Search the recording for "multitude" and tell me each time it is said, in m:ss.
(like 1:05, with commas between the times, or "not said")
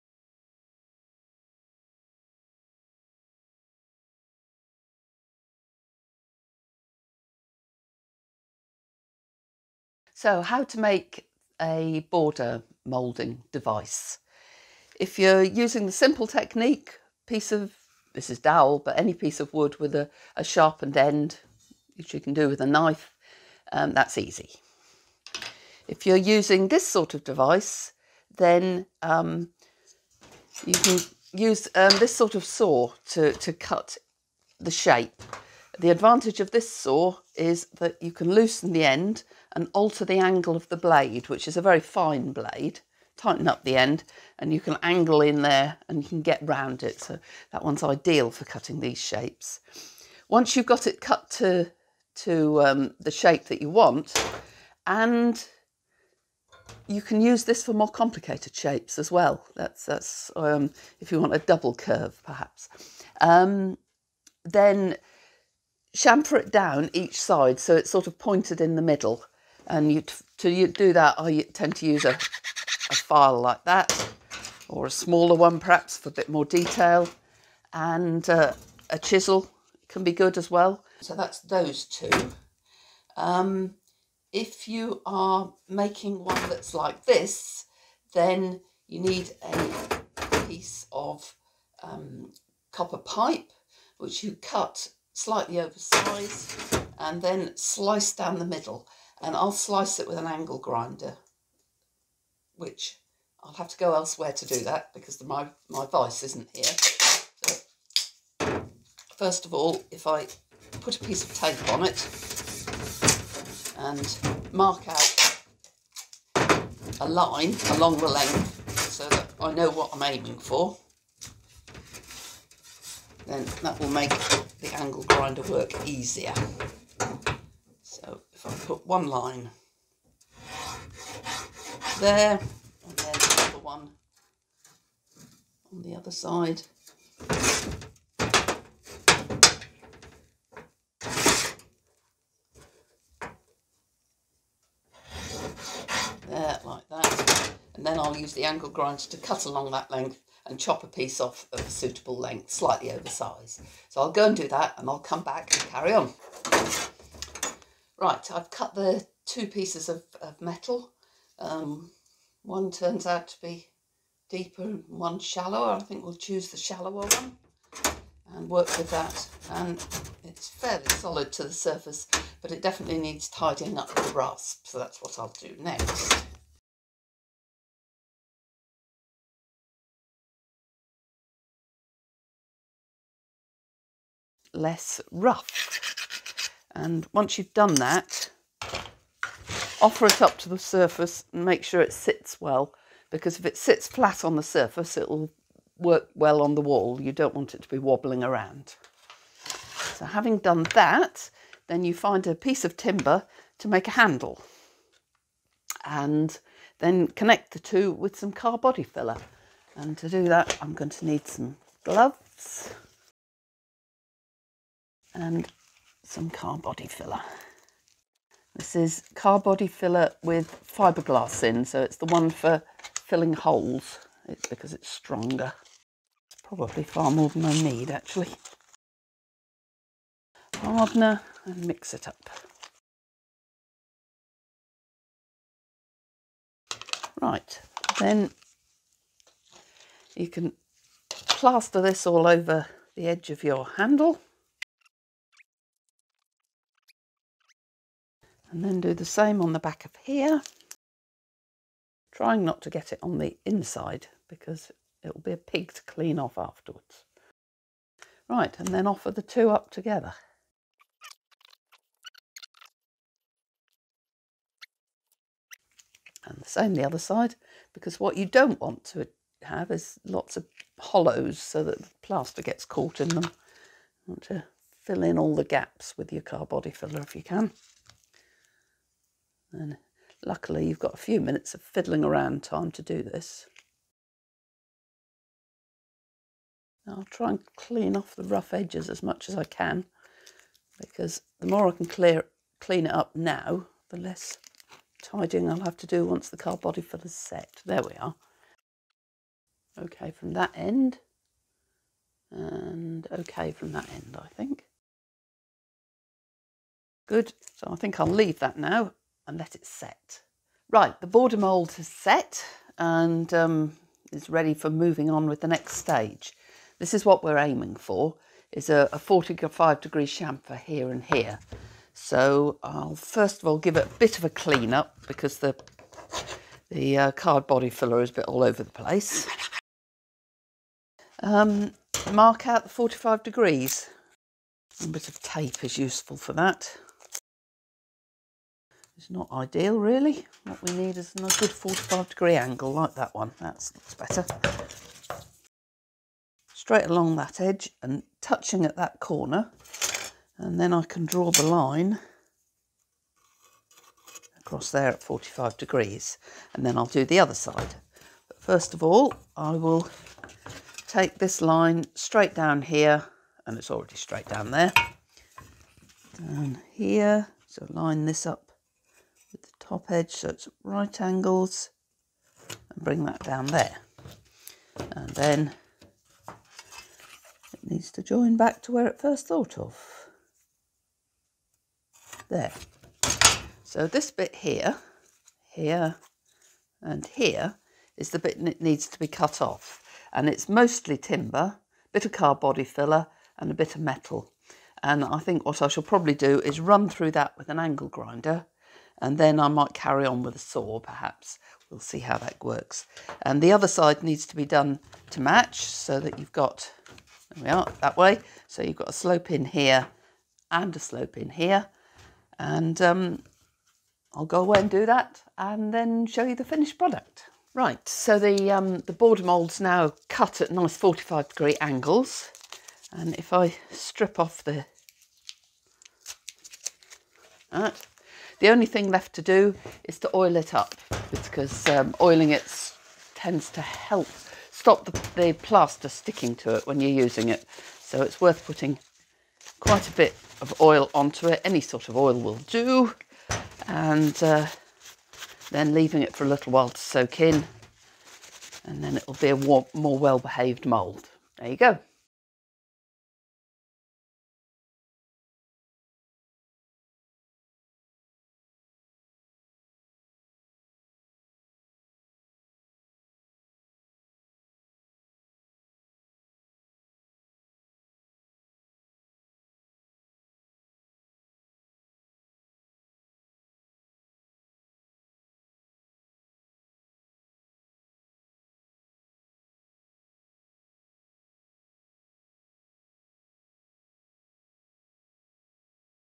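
not said.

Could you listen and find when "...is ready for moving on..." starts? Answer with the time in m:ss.
5:14.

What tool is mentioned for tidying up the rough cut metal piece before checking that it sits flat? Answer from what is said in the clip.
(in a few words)
Rasp.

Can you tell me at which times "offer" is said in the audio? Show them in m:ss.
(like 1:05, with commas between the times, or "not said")
3:09, 4:18.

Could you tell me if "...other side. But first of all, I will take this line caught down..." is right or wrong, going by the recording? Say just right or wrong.
wrong.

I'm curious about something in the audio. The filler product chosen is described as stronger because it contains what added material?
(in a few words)
Fiberglass.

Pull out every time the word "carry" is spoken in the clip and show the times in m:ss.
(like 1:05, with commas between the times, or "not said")
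2:35, 6:39.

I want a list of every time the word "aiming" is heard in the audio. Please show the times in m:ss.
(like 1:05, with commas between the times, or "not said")
2:00, 5:17.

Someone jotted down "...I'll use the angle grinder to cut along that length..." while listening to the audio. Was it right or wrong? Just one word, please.
right.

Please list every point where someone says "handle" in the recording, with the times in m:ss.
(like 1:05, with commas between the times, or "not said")
3:23, 4:03.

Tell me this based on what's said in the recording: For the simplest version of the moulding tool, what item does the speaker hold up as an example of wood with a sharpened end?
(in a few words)
Dowel.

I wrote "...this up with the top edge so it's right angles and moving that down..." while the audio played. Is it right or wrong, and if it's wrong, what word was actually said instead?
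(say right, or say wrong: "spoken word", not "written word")
wrong: "bring", not "moving".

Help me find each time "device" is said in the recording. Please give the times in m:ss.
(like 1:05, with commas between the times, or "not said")
0:13, 0:27.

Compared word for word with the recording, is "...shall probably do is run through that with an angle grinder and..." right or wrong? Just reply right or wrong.
right.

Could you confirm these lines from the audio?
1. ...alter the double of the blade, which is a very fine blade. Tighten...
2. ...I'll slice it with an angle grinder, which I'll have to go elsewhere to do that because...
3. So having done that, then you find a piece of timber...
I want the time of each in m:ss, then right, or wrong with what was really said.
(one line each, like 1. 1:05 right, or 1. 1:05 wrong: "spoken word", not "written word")
1. 0:39 wrong: "angle", not "double"
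2. 1:39 right
3. 3:19 right.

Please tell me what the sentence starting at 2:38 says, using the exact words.
Right, I've cut the two pieces of, of metal.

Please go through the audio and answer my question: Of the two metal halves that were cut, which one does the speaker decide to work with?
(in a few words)
The shallower one.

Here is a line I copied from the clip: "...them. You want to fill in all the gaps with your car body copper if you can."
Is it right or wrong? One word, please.
wrong.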